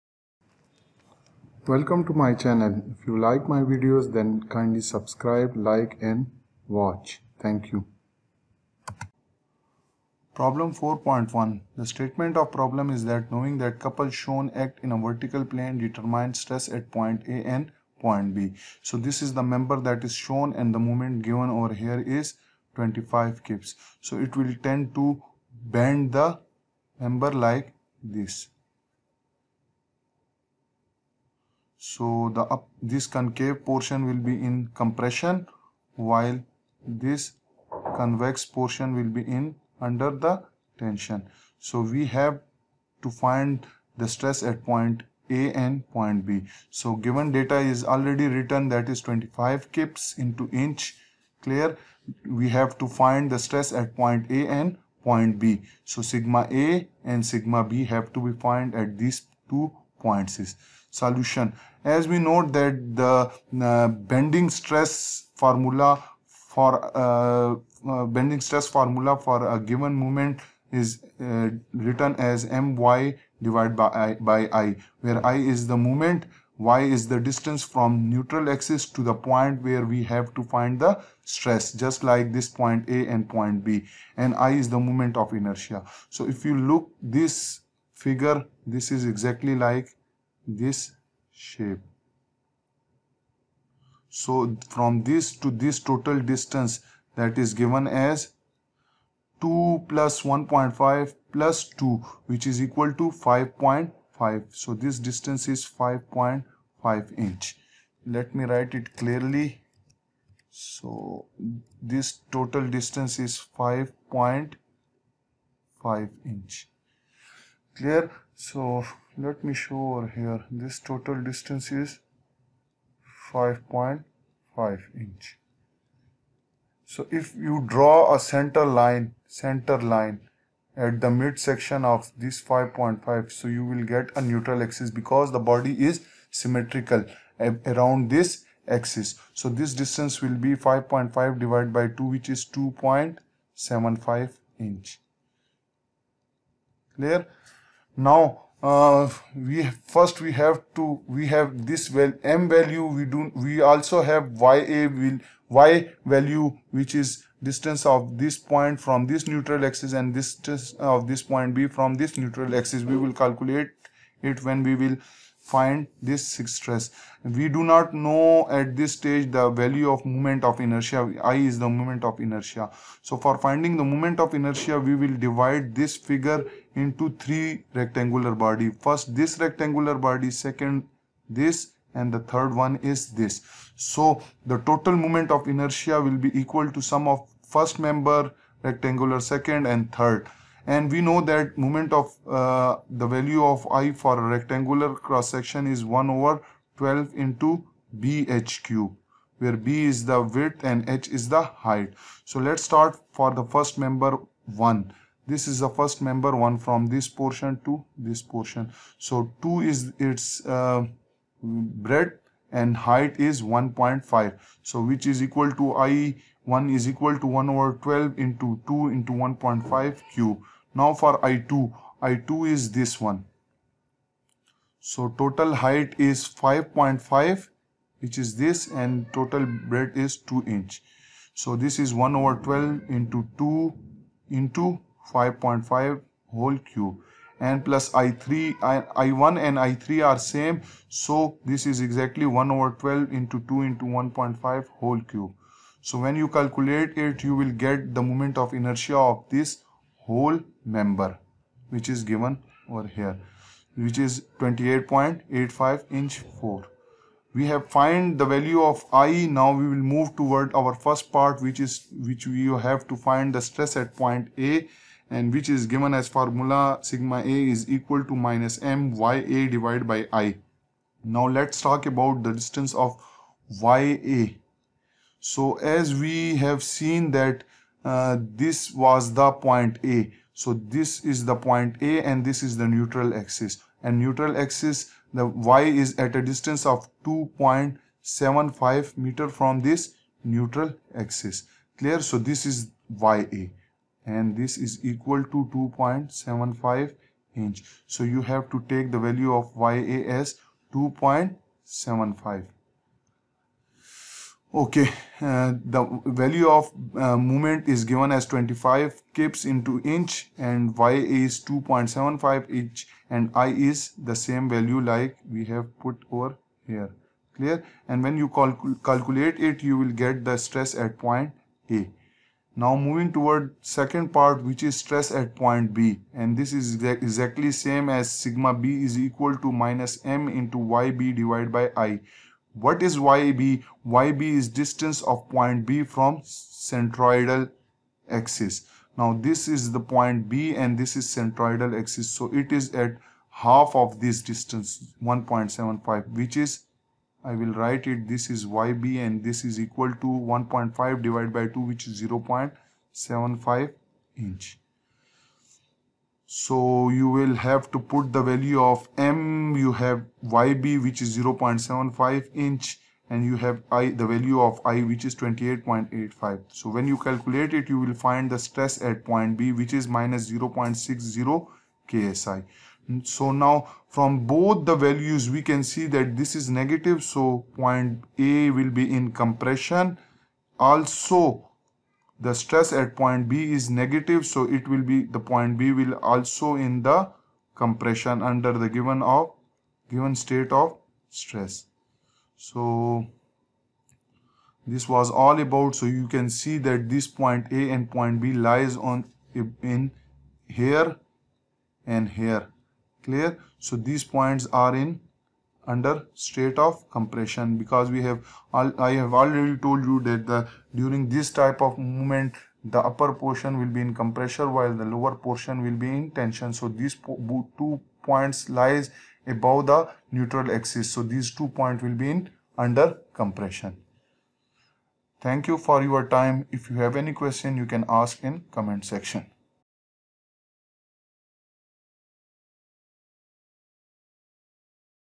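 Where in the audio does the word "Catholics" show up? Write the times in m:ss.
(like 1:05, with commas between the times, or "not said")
not said.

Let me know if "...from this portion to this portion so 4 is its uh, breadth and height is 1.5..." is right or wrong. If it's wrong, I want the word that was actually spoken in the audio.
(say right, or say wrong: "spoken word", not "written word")
wrong: "2", not "4".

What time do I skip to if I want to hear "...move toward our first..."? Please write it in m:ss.
4:19.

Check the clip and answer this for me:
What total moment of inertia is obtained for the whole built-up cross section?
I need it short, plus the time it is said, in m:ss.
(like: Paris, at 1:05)
28.85 in⁴, at 4:14.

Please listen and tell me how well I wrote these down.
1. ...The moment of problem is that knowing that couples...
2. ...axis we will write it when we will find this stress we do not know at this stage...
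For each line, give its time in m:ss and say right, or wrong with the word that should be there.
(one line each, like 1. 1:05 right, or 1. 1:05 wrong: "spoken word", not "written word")
1. 0:11 wrong: "statement", not "moment"
2. 2:42 wrong: "calculate", not "write".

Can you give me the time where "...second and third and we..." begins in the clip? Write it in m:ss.
3:09.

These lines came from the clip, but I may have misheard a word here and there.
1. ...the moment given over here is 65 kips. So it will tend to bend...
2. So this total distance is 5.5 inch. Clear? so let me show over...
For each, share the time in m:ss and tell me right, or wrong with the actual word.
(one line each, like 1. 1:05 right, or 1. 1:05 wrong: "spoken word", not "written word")
1. 0:20 wrong: "25", not "65"
2. 1:50 right.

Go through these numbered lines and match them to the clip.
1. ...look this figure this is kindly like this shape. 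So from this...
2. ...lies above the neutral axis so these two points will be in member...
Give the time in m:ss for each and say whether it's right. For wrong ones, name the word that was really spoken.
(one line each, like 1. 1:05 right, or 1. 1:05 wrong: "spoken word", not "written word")
1. 1:26 wrong: "exactly", not "kindly"
2. 6:58 wrong: "under", not "member".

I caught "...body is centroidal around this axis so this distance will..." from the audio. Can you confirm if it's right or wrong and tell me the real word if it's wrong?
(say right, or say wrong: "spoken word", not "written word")
wrong: "symmetrical", not "centroidal".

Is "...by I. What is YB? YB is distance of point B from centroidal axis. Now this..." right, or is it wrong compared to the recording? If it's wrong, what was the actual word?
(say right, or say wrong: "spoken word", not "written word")
right.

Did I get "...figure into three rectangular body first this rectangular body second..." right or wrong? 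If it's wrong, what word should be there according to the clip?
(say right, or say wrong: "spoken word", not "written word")
right.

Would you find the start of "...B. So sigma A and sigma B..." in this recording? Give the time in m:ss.
0:55.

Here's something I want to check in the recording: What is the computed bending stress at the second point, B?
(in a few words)
-0.60 ksi.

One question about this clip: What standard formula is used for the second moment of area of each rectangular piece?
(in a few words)
1/12 bh³.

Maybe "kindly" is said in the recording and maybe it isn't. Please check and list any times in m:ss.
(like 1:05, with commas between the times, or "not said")
0:04.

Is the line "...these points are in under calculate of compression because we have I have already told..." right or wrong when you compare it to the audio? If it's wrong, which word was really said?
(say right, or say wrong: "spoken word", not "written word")
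wrong: "state", not "calculate".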